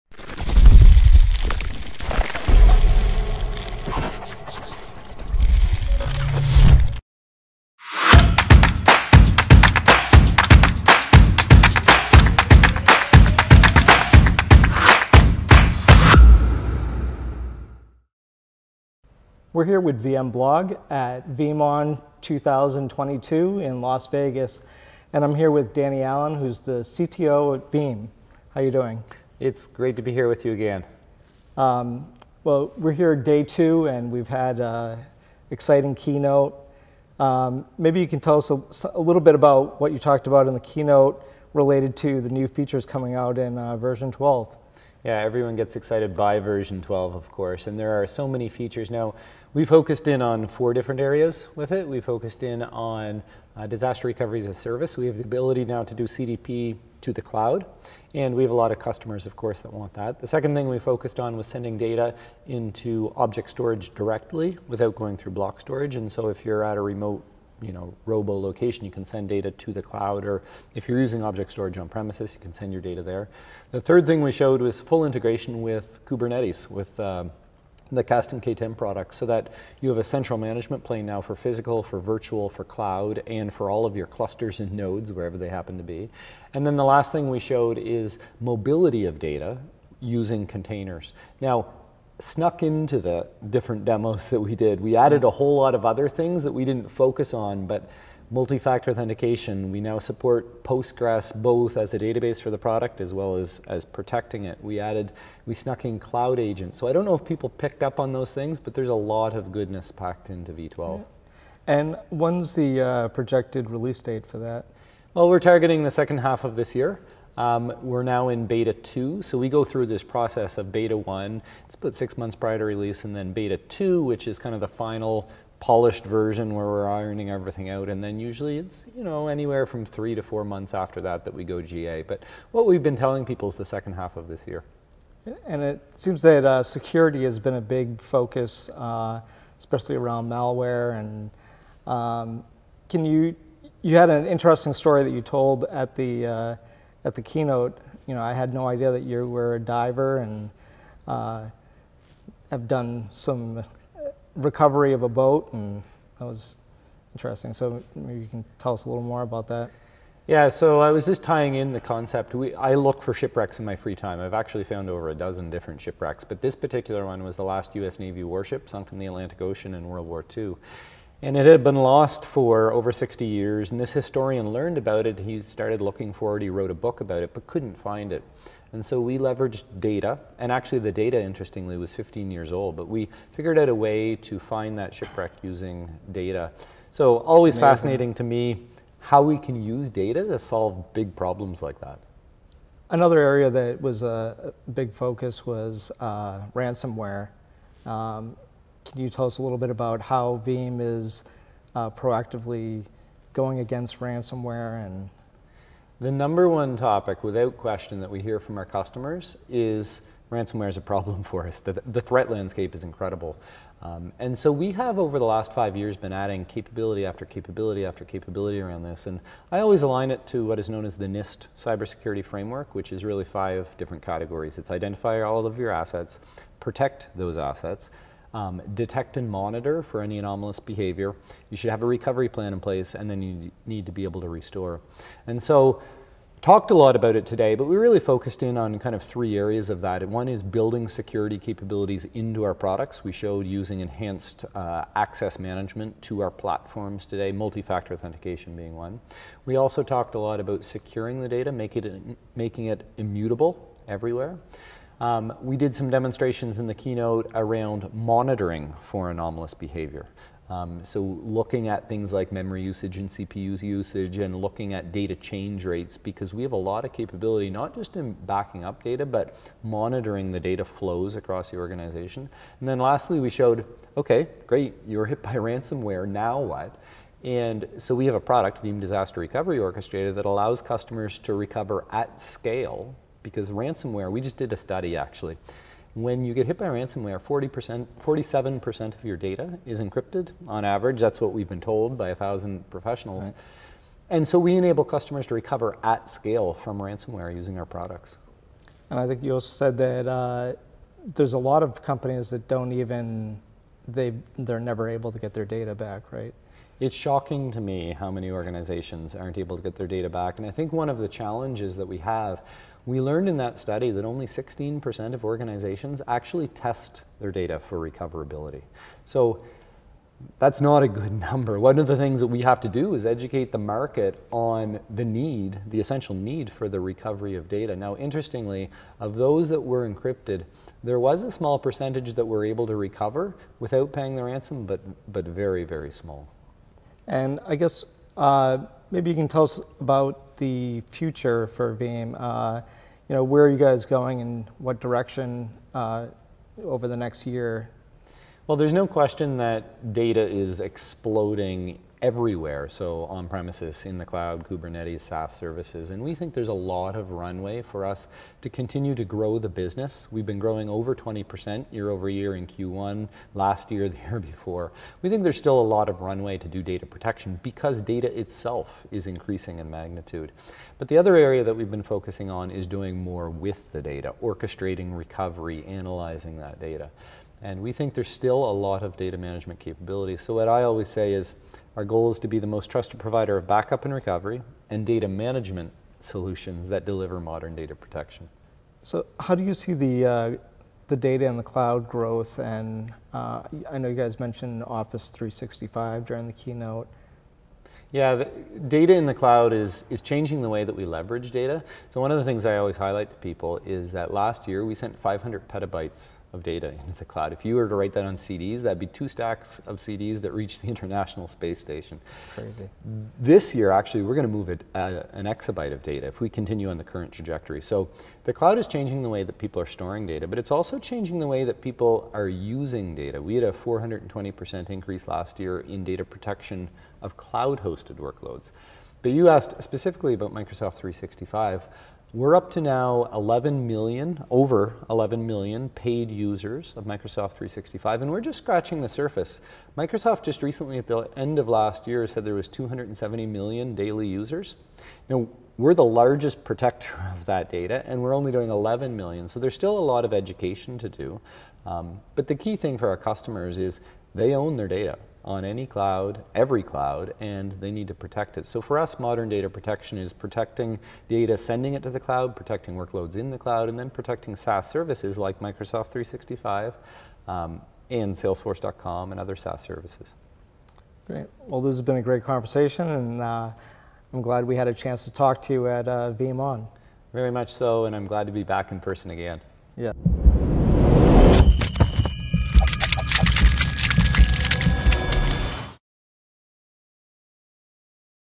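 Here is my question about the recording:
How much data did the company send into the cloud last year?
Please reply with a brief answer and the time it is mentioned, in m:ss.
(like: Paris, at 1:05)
500 petabytes, at 6:45.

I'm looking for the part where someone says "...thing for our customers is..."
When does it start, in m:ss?
7:32.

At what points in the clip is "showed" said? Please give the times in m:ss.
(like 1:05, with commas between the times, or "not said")
1:14, 1:27, 4:03, 4:33.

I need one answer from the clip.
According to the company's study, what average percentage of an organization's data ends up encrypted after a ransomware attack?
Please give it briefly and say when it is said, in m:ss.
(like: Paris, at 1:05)
47%, at 4:48.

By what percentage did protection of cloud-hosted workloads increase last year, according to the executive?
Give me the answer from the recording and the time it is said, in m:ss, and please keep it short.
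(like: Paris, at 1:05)
420%, at 7:03.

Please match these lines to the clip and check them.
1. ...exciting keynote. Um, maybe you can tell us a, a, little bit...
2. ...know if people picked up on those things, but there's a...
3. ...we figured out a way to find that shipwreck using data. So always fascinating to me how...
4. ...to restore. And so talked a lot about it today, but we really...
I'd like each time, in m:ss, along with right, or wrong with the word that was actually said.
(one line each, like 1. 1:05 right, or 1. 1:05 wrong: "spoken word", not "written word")
1. 0:35 right
2. 1:47 right
3. 3:02 right
4. 3:54 right.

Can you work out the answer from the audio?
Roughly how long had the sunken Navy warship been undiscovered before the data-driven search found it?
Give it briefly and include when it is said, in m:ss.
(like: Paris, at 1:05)
over 60 years, at 2:52.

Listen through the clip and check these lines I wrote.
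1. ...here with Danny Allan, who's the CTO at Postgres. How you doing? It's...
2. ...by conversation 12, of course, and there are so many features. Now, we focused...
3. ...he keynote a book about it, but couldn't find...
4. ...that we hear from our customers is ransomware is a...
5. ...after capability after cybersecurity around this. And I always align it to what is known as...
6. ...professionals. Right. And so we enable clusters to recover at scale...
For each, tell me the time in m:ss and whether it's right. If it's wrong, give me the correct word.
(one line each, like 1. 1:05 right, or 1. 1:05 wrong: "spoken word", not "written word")
1. 0:25 wrong: "Veeam", not "Postgres"
2. 0:46 wrong: "version", not "conversation"
3. 2:56 wrong: "wrote", not "keynote"
4. 3:28 right
5. 3:37 wrong: "capability", not "cybersecurity"
6. 4:52 wrong: "customers", not "clusters".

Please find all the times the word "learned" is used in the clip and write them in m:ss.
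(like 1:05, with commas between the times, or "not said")
2:54, 5:12.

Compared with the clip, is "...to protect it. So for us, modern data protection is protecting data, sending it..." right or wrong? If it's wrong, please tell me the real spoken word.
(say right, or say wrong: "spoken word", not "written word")
right.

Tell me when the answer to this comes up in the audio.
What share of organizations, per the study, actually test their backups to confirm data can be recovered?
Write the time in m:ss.
5:14.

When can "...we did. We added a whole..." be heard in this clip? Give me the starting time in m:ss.
1:34.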